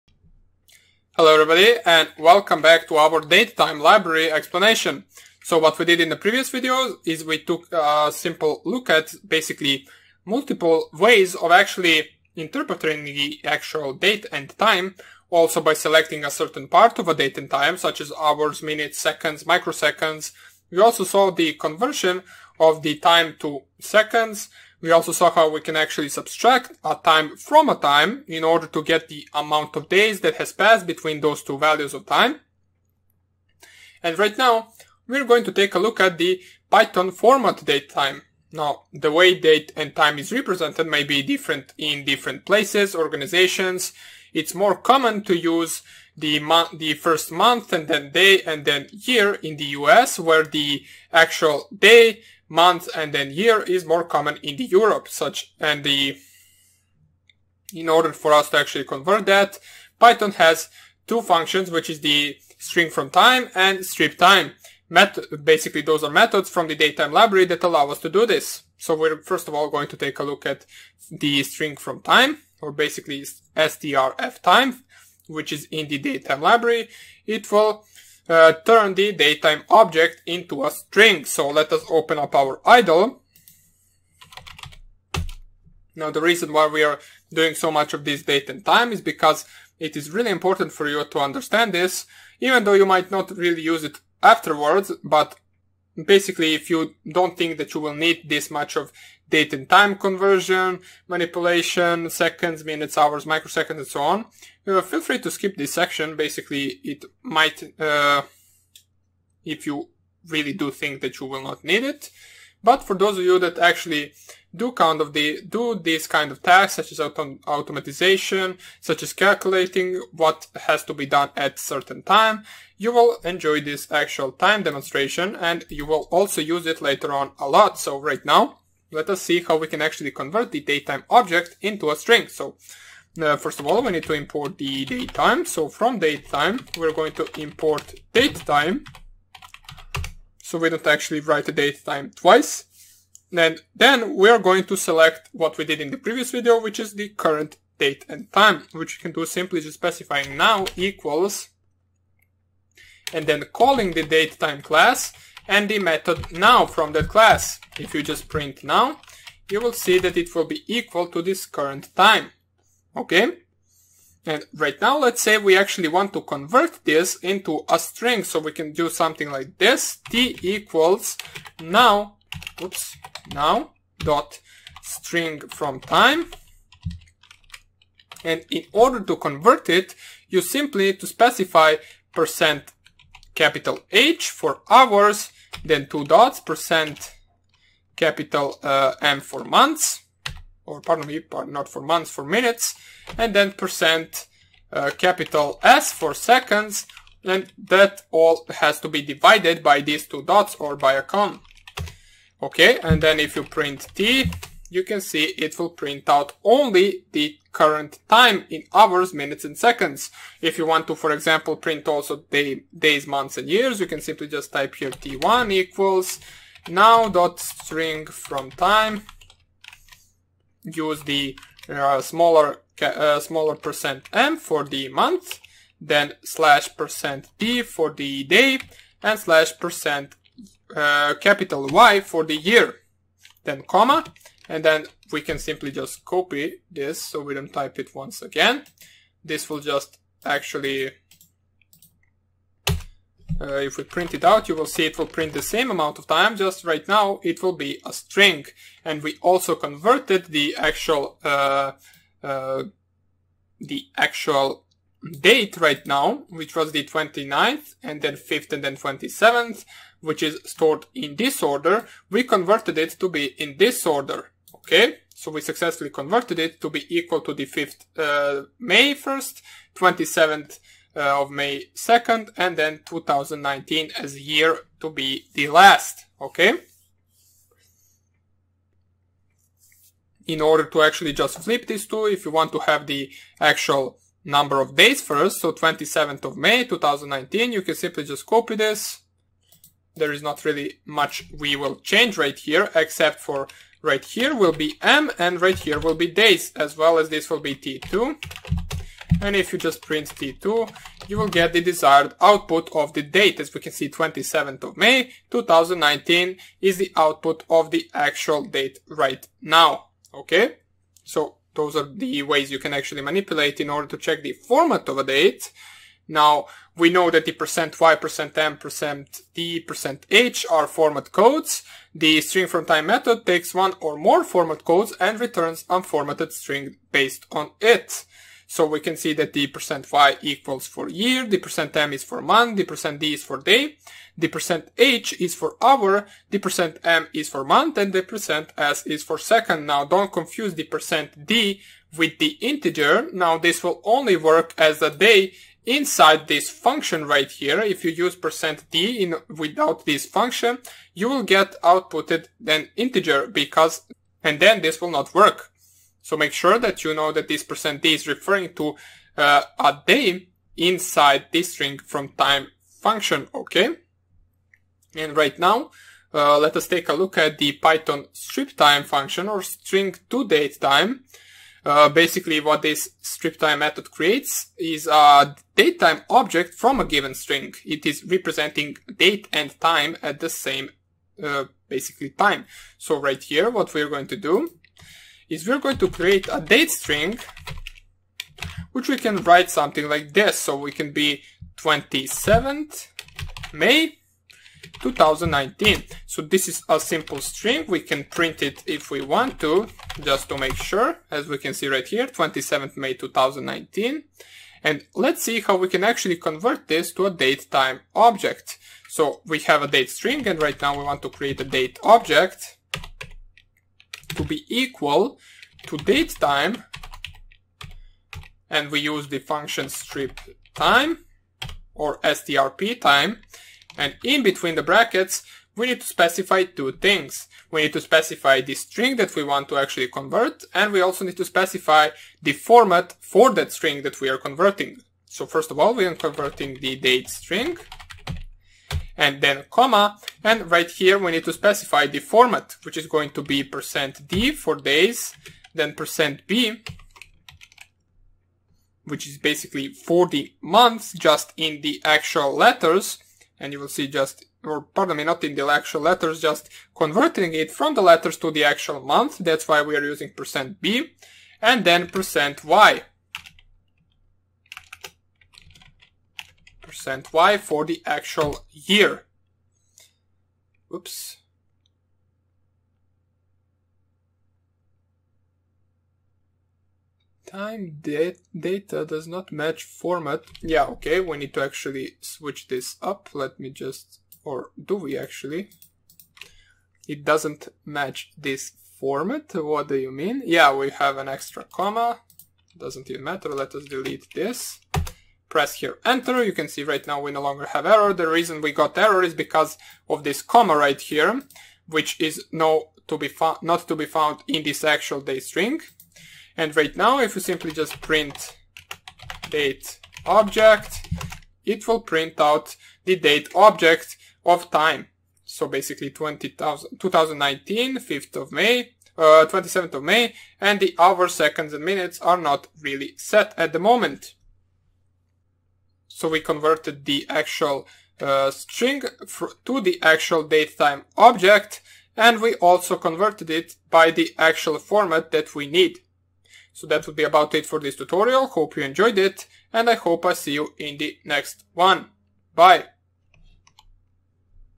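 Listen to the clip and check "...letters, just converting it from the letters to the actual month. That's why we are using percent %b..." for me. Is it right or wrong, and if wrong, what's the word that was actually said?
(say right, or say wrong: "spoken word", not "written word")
right.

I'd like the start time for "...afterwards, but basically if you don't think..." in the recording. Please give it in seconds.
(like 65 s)
94 s.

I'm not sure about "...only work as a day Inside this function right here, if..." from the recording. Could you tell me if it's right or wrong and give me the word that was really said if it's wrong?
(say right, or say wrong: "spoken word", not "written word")
right.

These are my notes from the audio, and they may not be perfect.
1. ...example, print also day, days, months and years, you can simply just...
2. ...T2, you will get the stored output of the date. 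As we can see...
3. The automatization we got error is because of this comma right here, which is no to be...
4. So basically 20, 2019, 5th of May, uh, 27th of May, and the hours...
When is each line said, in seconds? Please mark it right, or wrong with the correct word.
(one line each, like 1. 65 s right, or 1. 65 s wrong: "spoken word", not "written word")
1. 211 s right
2. 300 s wrong: "desired", not "stored"
3. 497 s wrong: "reason", not "automatization"
4. 515 s right.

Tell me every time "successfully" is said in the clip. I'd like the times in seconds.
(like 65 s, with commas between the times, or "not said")
265 s.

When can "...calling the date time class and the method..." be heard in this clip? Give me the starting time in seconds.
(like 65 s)
153 s.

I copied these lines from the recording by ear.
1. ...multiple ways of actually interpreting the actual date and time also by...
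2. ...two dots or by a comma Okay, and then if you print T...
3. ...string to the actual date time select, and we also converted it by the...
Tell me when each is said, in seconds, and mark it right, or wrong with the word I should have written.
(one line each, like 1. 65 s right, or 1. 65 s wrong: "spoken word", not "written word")
1. 10 s right
2. 200 s right
3. 528 s wrong: "object", not "select".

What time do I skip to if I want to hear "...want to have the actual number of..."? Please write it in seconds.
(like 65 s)
282 s.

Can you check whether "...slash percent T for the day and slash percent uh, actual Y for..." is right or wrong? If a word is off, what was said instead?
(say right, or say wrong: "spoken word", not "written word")
wrong: "capital", not "actual".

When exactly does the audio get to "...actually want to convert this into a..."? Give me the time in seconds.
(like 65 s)
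165 s.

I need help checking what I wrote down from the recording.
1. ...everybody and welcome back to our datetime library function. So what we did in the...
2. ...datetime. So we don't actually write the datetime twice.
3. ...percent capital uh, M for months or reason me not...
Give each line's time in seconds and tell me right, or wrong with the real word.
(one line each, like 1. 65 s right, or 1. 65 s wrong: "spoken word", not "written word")
1. 1 s wrong: "explanation", not "function"
2. 138 s right
3. 186 s wrong: "pardon", not "reason".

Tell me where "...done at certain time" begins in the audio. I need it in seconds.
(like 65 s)
121 s.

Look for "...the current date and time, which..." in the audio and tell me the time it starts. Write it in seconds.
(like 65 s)
146 s.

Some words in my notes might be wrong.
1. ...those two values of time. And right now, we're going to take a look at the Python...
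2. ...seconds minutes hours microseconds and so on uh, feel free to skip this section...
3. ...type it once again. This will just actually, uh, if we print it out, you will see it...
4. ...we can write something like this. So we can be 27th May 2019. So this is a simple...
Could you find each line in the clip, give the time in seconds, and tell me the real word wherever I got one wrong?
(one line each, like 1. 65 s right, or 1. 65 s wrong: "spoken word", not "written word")
1. 31 s right
2. 102 s right
3. 237 s right
4. 388 s right.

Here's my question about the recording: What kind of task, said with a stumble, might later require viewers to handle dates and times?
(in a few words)
automatization.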